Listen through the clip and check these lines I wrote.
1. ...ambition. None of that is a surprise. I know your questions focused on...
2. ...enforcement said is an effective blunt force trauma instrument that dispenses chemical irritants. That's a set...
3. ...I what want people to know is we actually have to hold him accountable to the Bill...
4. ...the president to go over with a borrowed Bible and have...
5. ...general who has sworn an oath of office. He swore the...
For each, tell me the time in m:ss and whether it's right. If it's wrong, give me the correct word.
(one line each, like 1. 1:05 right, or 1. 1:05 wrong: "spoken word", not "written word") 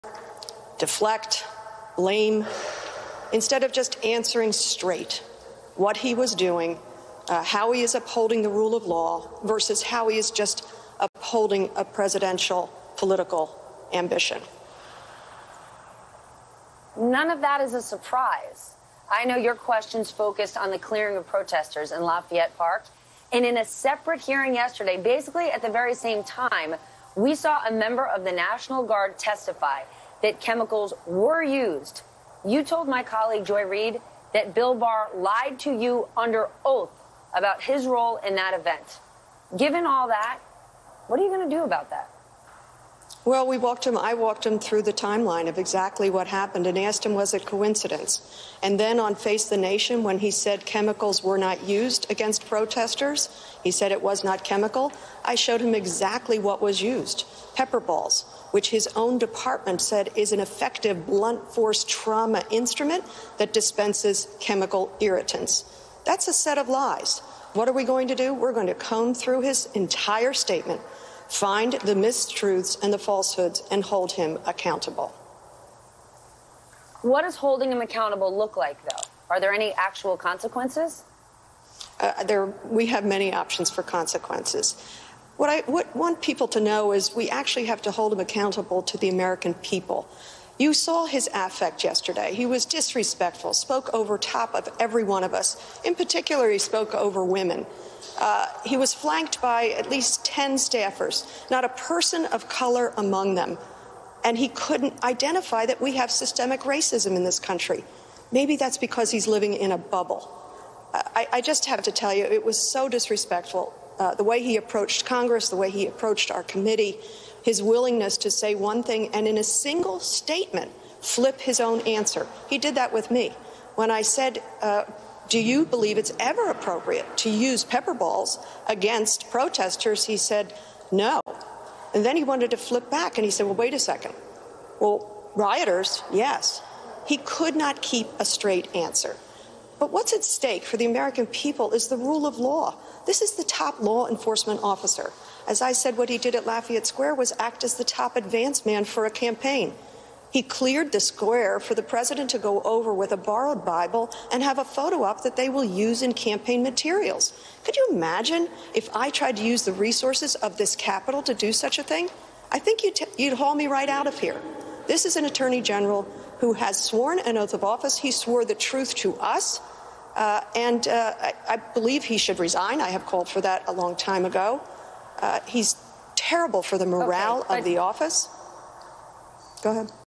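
1. 0:13 right
2. 0:59 wrong: "department", not "enforcement"
3. 1:25 wrong: "American", not "Bill"
4. 2:31 right
5. 2:45 right.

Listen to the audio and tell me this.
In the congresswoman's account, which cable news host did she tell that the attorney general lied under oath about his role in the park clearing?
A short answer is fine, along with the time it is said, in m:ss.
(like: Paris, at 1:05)
Joy Reid, at 0:33.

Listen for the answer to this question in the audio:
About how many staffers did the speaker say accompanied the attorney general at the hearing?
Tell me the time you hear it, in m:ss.
1:40.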